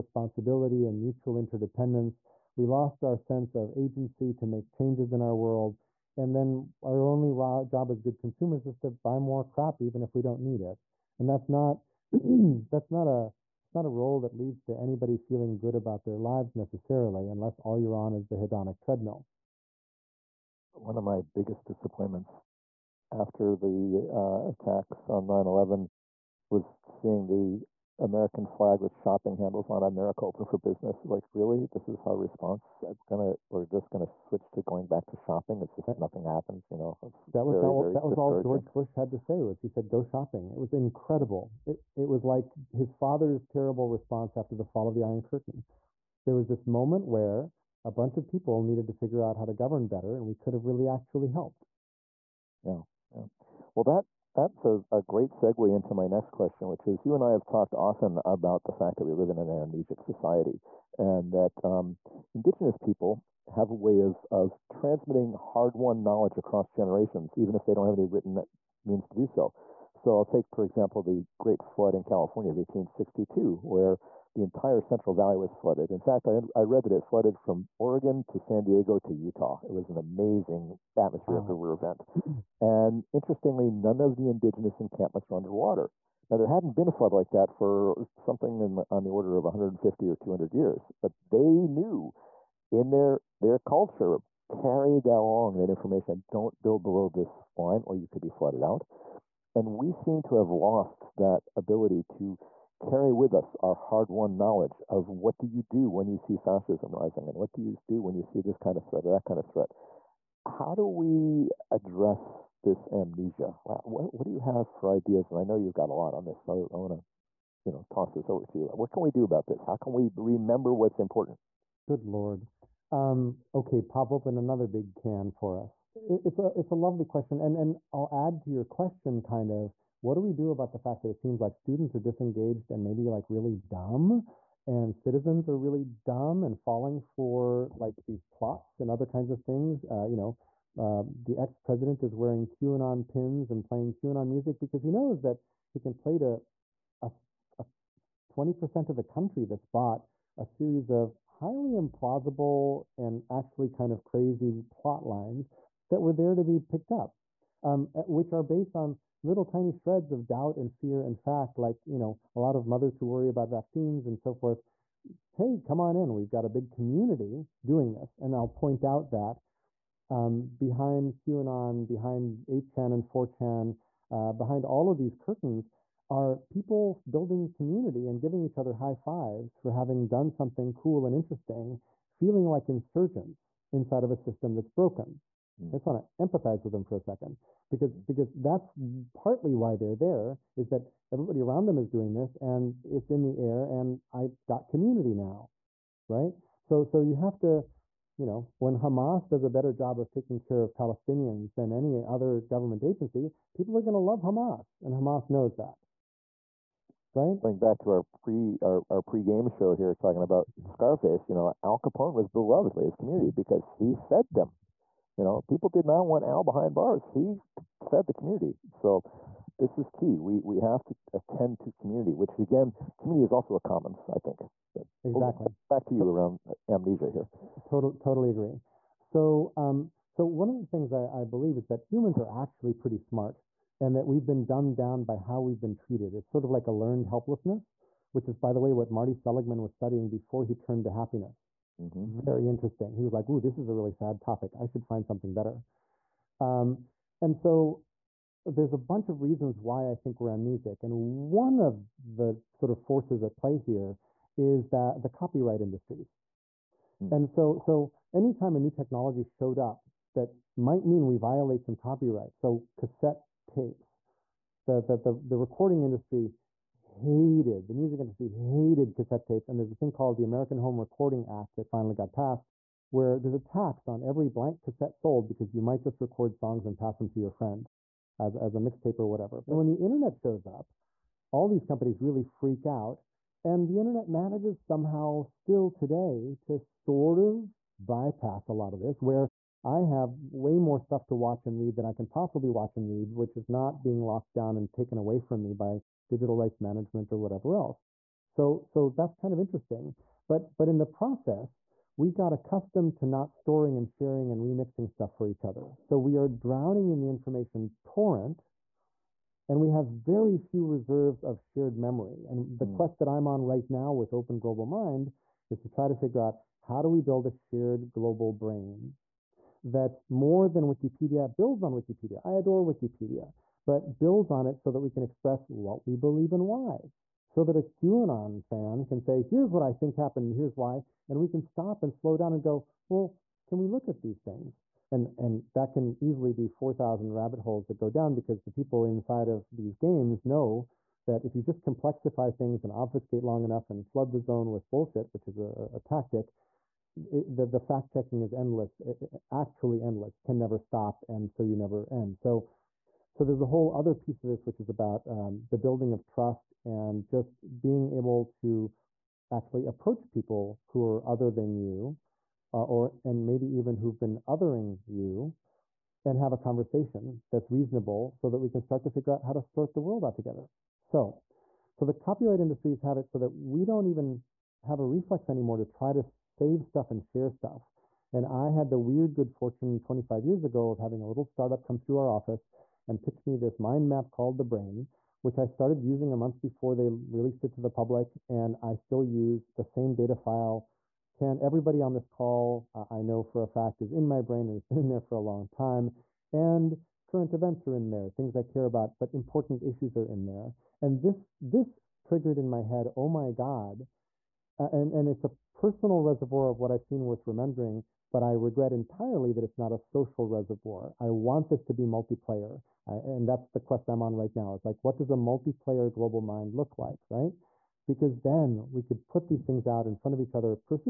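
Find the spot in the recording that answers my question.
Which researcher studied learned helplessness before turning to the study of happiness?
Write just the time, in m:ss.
3:58.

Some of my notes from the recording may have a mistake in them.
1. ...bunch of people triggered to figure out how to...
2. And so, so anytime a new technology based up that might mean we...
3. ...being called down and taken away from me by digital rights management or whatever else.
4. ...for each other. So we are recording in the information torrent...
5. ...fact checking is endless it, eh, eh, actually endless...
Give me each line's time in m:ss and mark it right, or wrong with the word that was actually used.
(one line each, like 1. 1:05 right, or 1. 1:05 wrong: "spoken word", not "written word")
1. 0:47 wrong: "needed", not "triggered"
2. 4:17 wrong: "showed", not "based"
3. 4:53 wrong: "locked", not "called"
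4. 5:05 wrong: "drowning", not "recording"
5. 5:47 right.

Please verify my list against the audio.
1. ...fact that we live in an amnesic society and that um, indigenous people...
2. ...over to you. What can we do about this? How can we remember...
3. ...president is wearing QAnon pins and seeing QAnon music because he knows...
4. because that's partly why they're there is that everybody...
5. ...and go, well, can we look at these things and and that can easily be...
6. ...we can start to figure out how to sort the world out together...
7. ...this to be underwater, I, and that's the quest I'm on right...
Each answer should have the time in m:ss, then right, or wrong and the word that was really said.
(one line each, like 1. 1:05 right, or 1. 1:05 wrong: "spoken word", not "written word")
1. 0:58 right
2. 1:58 right
3. 2:21 wrong: "playing", not "seeing"
4. 3:08 right
5. 5:32 right
6. 6:08 right
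7. 6:51 wrong: "multiplayer", not "underwater".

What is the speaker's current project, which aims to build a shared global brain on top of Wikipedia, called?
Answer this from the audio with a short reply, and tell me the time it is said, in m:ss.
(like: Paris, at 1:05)
Open Global Mind, at 5:14.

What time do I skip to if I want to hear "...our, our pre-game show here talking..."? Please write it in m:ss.
3:28.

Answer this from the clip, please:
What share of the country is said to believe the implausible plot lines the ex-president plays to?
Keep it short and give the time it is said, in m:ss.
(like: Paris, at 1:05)
20%, at 2:28.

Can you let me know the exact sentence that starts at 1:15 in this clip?
In fact, I, I read that it flooded from Oregon to San Diego to Utah.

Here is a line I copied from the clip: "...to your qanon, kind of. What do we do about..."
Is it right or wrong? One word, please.
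wrong.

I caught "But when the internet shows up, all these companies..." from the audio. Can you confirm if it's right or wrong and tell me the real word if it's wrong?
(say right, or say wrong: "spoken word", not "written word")
right.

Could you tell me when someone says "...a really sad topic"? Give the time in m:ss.
4:03.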